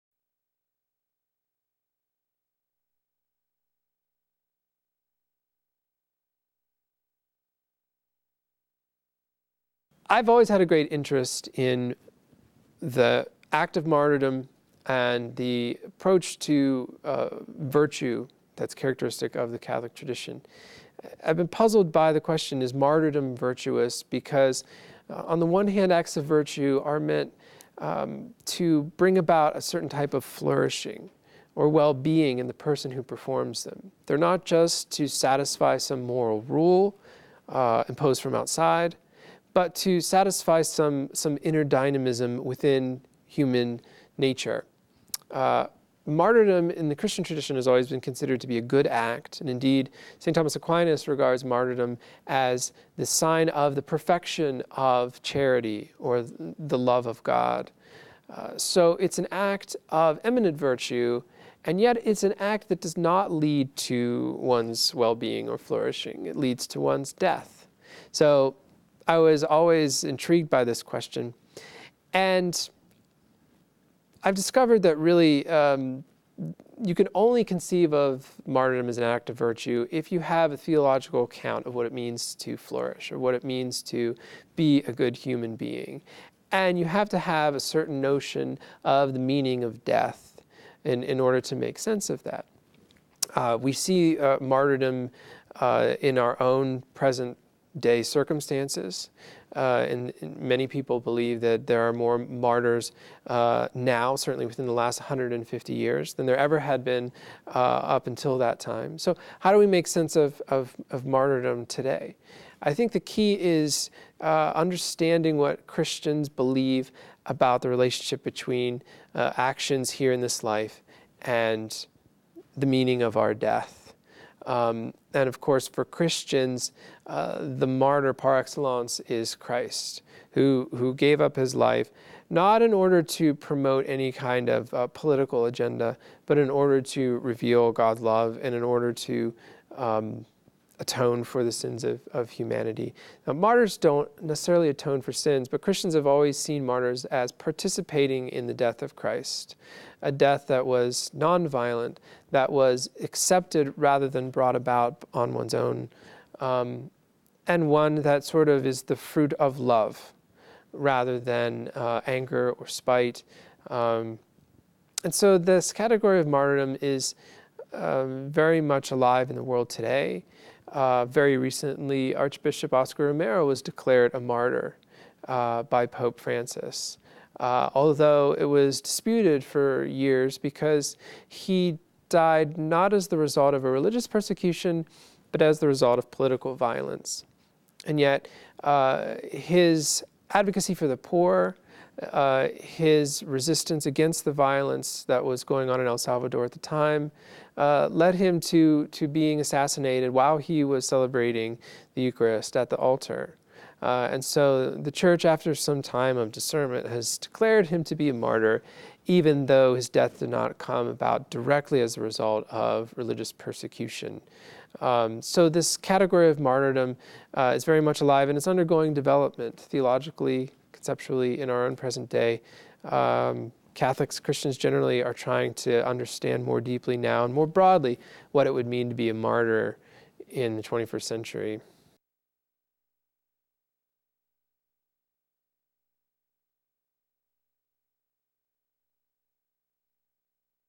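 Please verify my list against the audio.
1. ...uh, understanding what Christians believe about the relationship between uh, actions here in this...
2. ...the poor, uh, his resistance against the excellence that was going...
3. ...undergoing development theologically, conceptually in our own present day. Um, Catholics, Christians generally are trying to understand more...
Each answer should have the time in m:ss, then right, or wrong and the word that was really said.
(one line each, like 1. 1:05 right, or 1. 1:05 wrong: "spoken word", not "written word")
1. 1:54 right
2. 3:10 wrong: "violence", not "excellence"
3. 3:38 right.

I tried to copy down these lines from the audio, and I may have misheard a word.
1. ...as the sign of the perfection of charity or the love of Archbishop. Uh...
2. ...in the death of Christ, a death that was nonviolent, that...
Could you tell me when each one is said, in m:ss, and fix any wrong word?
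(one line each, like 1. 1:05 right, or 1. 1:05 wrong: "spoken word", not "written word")
1. 0:52 wrong: "God", not "Archbishop"
2. 2:28 right.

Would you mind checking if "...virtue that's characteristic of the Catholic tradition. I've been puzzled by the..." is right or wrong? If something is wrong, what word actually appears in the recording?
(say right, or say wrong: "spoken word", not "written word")
right.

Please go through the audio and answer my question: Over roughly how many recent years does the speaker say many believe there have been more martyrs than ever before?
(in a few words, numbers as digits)
150.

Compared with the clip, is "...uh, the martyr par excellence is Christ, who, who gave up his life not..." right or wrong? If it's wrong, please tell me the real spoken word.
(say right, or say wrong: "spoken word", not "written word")
right.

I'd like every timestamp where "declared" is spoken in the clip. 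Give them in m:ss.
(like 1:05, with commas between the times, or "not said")
2:53, 3:27.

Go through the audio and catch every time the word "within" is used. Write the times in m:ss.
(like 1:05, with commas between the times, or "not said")
0:42, 1:44.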